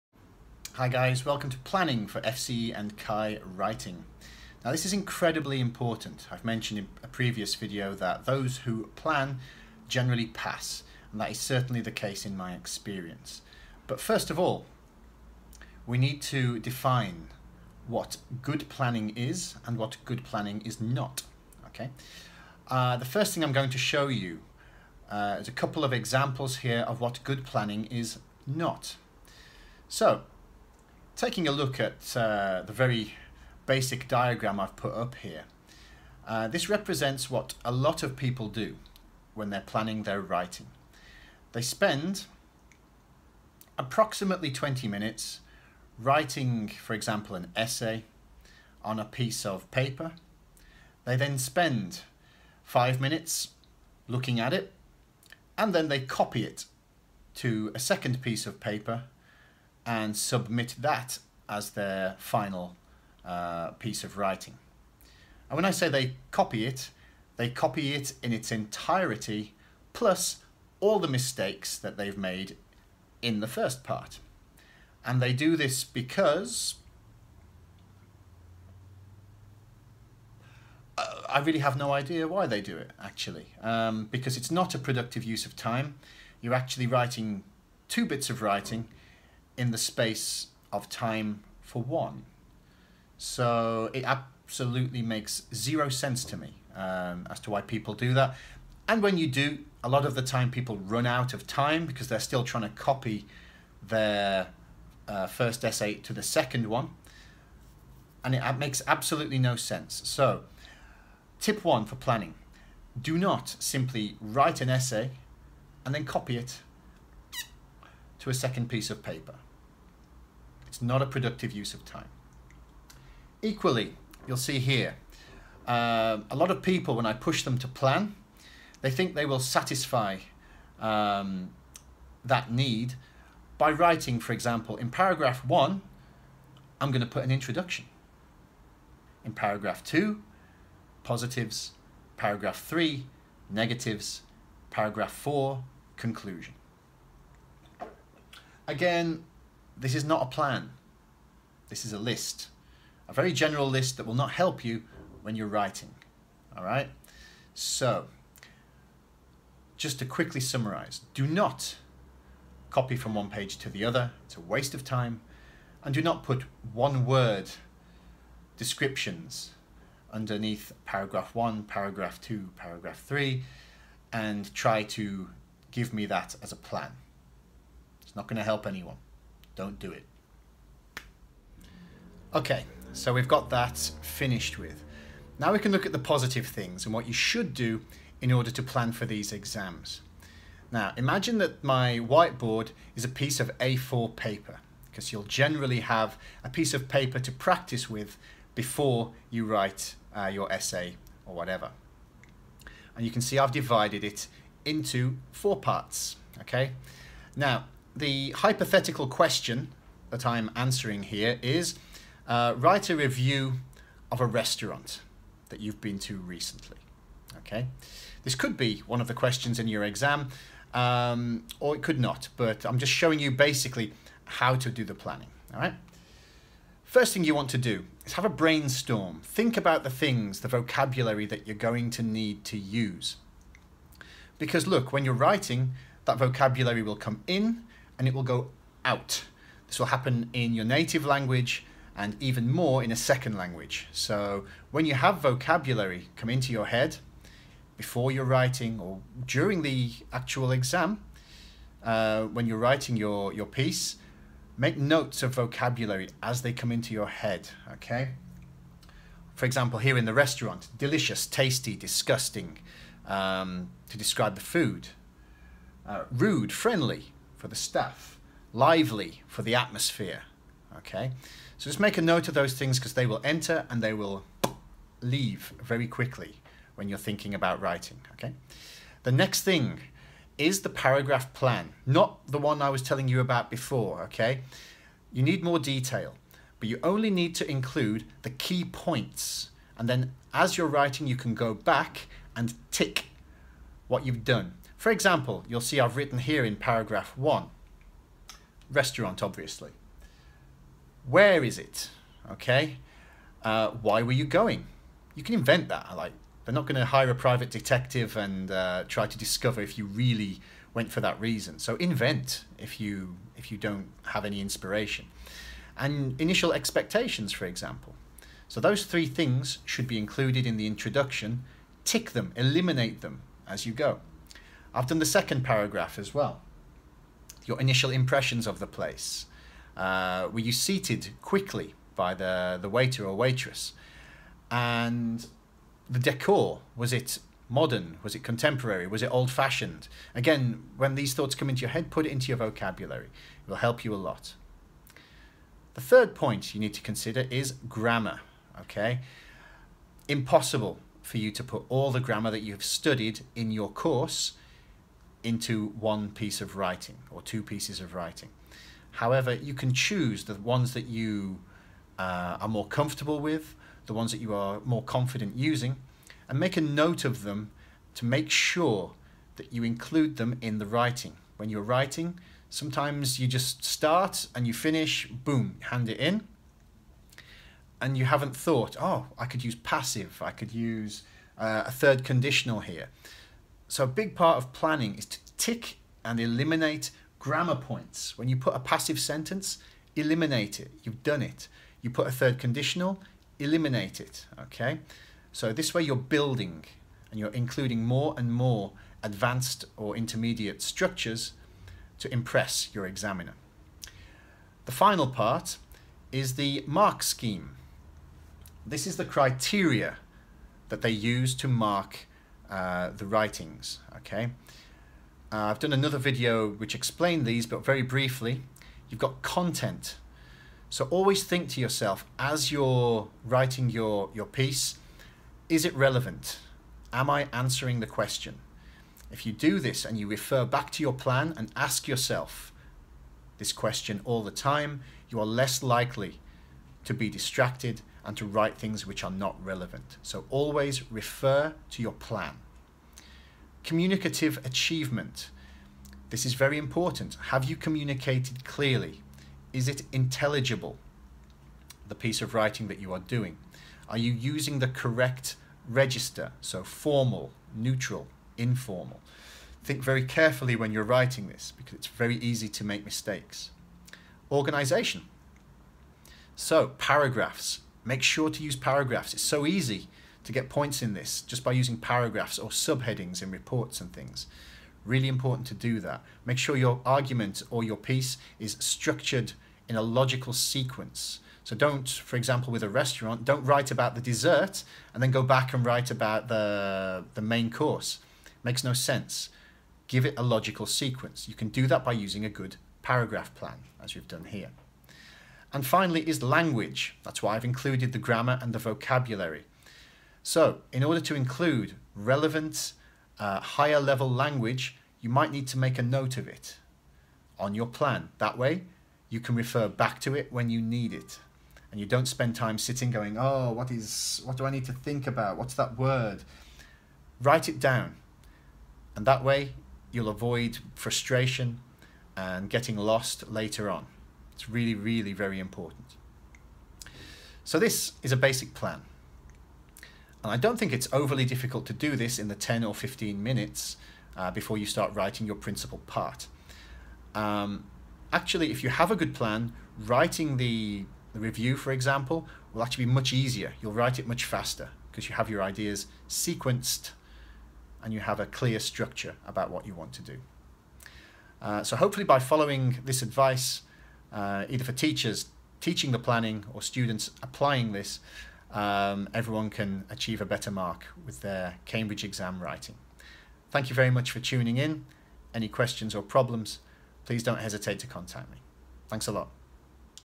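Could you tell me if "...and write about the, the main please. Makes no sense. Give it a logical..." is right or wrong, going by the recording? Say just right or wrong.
wrong.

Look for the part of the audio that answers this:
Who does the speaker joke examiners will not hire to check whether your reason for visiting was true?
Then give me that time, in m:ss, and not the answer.
5:07.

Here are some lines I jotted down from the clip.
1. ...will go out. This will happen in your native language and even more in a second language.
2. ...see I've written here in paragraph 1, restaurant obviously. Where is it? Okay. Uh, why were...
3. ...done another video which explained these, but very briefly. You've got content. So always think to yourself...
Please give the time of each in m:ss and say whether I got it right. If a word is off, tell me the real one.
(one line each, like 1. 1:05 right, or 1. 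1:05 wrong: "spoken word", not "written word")
1. 3:58 right
2. 4:55 right
3. 6:55 right.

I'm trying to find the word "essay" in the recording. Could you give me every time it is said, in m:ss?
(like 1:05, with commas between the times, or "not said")
0:47, 1:45, 1:54, 3:20.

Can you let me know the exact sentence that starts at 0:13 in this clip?
But first of all, we need to define what good planning is and what good planning is not.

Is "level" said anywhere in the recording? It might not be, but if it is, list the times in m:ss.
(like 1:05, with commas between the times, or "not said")
8:23.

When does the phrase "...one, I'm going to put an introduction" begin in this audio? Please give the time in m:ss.
2:15.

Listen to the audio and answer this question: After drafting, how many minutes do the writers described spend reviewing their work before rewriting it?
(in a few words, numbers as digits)
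5 minutes.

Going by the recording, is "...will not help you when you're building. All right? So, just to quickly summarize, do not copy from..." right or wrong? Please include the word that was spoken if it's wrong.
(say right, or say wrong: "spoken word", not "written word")
wrong: "writing", not "building".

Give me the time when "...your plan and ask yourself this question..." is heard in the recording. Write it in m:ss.
7:10.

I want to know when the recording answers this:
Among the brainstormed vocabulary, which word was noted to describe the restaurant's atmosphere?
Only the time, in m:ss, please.
4:28.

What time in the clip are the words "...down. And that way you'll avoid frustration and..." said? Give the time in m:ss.
8:37.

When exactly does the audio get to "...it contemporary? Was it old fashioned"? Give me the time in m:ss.
5:38.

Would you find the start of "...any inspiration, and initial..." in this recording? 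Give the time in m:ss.
5:14.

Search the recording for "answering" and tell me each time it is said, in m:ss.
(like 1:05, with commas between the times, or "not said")
3:30, 7:07.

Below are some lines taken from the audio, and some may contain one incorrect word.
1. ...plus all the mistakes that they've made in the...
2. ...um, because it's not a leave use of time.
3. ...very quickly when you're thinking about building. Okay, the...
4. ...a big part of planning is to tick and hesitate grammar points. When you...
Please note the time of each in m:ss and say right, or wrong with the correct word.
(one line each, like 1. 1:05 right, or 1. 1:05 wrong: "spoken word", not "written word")
1. 1:09 right
2. 1:23 wrong: "productive", not "leave"
3. 4:35 wrong: "writing", not "building"
4. 6:23 wrong: "eliminate", not "hesitate".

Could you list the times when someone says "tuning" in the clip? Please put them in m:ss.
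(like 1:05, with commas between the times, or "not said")
9:24.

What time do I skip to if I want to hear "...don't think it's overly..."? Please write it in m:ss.
8:50.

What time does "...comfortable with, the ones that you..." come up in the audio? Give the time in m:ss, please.
6:02.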